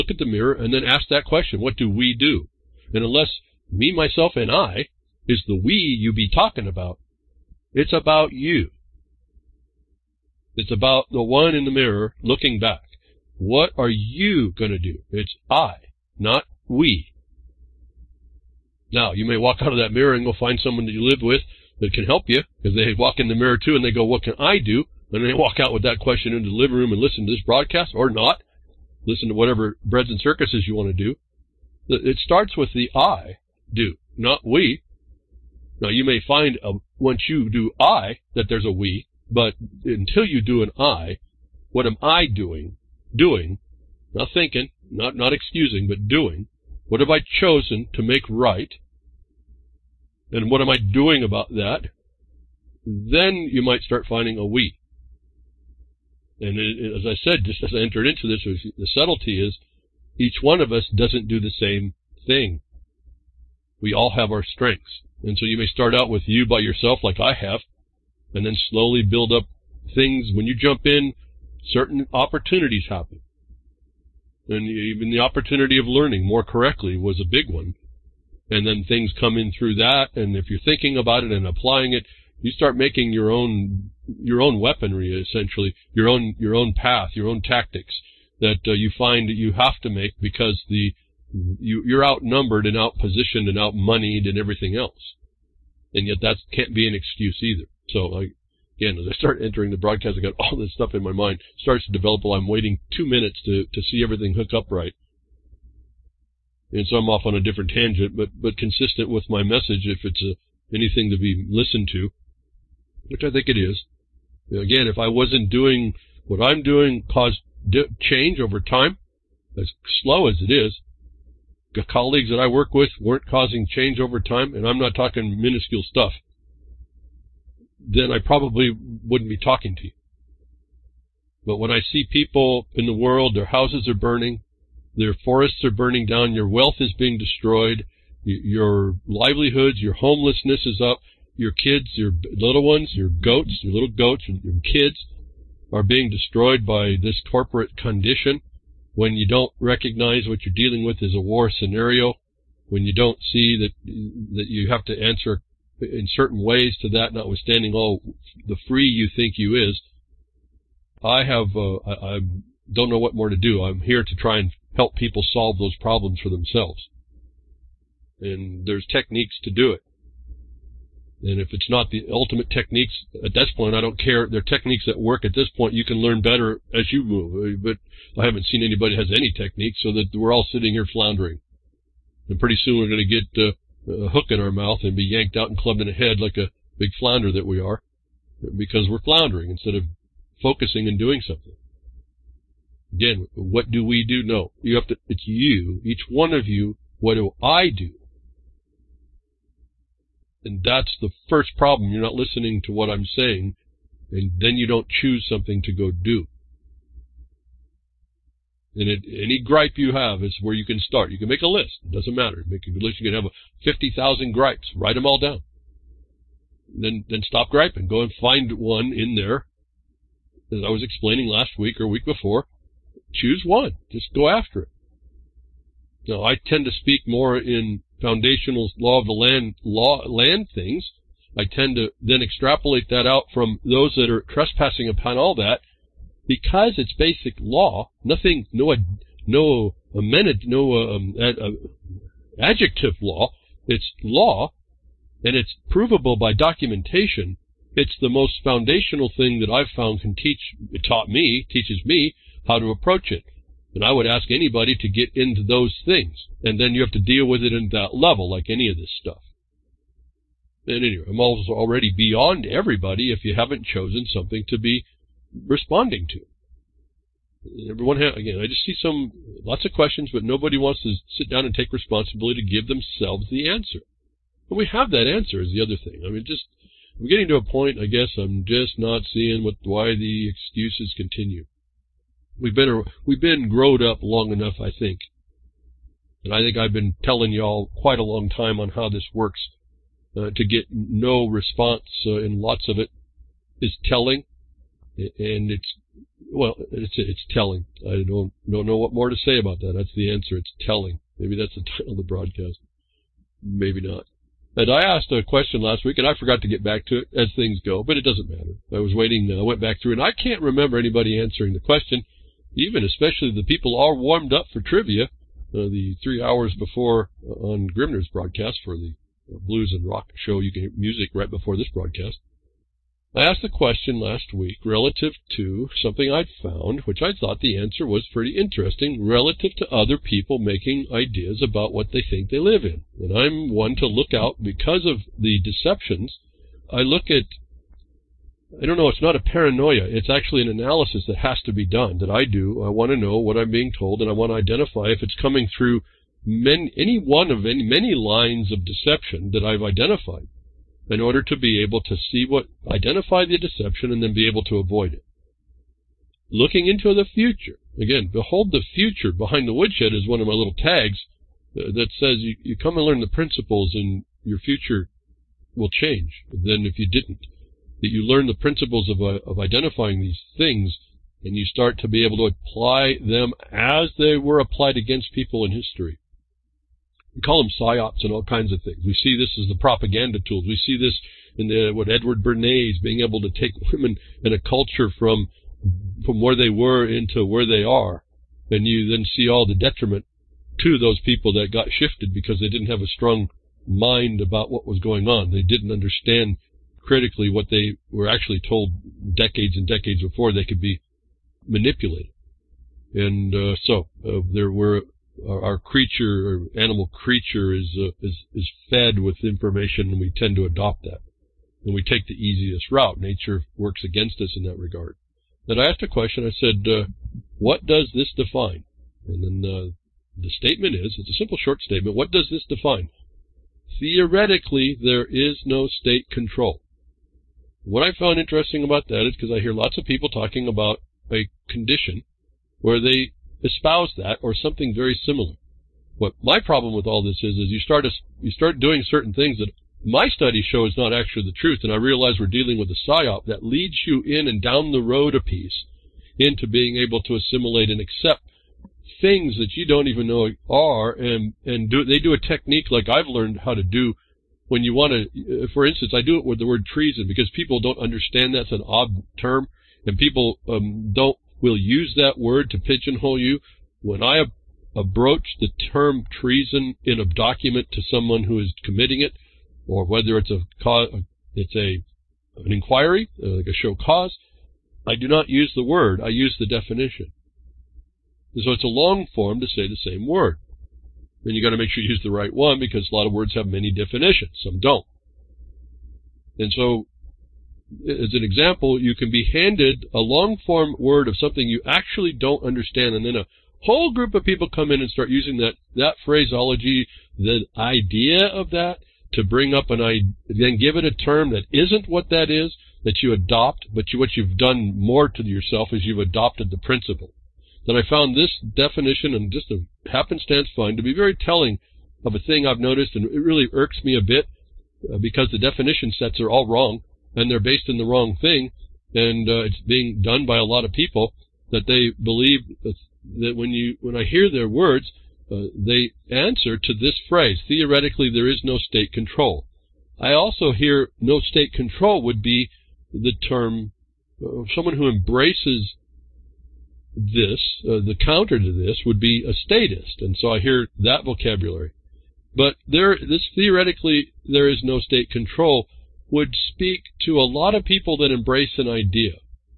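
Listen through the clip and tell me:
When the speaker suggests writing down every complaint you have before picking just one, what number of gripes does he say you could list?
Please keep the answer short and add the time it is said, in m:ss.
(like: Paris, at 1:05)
50,000, at 3:33.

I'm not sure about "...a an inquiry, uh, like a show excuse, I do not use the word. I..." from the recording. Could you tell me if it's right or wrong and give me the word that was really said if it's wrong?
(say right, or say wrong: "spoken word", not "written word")
wrong: "cause", not "excuse".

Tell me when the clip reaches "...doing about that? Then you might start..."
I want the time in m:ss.
0:50.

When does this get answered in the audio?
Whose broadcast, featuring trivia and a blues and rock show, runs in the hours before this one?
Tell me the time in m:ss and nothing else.
5:17.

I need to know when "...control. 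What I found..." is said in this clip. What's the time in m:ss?
7:06.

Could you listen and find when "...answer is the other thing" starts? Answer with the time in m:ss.
4:35.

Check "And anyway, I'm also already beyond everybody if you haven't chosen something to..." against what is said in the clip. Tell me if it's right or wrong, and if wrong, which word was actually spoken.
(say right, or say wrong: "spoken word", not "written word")
right.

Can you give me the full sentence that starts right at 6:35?
They didn't understand critically what they were actually told decades and decades before they could be manipulated.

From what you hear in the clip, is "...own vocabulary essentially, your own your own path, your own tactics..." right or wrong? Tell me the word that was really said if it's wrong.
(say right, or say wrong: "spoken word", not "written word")
wrong: "weaponry", not "vocabulary".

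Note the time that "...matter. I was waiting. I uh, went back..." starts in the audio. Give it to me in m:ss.
5:08.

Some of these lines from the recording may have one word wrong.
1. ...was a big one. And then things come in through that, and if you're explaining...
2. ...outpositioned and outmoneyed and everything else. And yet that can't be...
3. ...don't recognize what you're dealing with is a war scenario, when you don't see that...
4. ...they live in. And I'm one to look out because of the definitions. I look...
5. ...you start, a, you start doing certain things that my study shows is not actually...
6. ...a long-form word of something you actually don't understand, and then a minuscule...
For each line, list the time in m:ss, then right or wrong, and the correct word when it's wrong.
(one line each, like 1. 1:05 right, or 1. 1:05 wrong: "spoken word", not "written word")
1. 1:16 wrong: "thinking", not "explaining"
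2. 1:32 right
3. 2:29 right
4. 5:32 wrong: "deceptions", not "definitions"
5. 7:17 right
6. 8:09 wrong: "whole", not "minuscule".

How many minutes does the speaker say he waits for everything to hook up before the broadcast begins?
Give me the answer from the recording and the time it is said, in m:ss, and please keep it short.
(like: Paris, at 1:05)
2, at 1:42.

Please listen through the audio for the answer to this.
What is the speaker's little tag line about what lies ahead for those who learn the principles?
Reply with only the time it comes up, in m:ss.
5:58.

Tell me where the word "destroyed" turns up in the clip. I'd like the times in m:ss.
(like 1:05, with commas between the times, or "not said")
2:17, 2:26.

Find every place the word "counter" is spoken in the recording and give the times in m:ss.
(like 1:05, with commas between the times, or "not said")
8:57.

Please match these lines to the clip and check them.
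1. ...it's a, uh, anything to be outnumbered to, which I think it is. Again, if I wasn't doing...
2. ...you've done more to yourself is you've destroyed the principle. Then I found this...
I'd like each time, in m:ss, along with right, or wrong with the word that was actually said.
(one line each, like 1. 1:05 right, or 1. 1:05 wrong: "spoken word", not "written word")
1. 1:50 wrong: "listened", not "outnumbered"
2. 8:24 wrong: "adopted", not "destroyed".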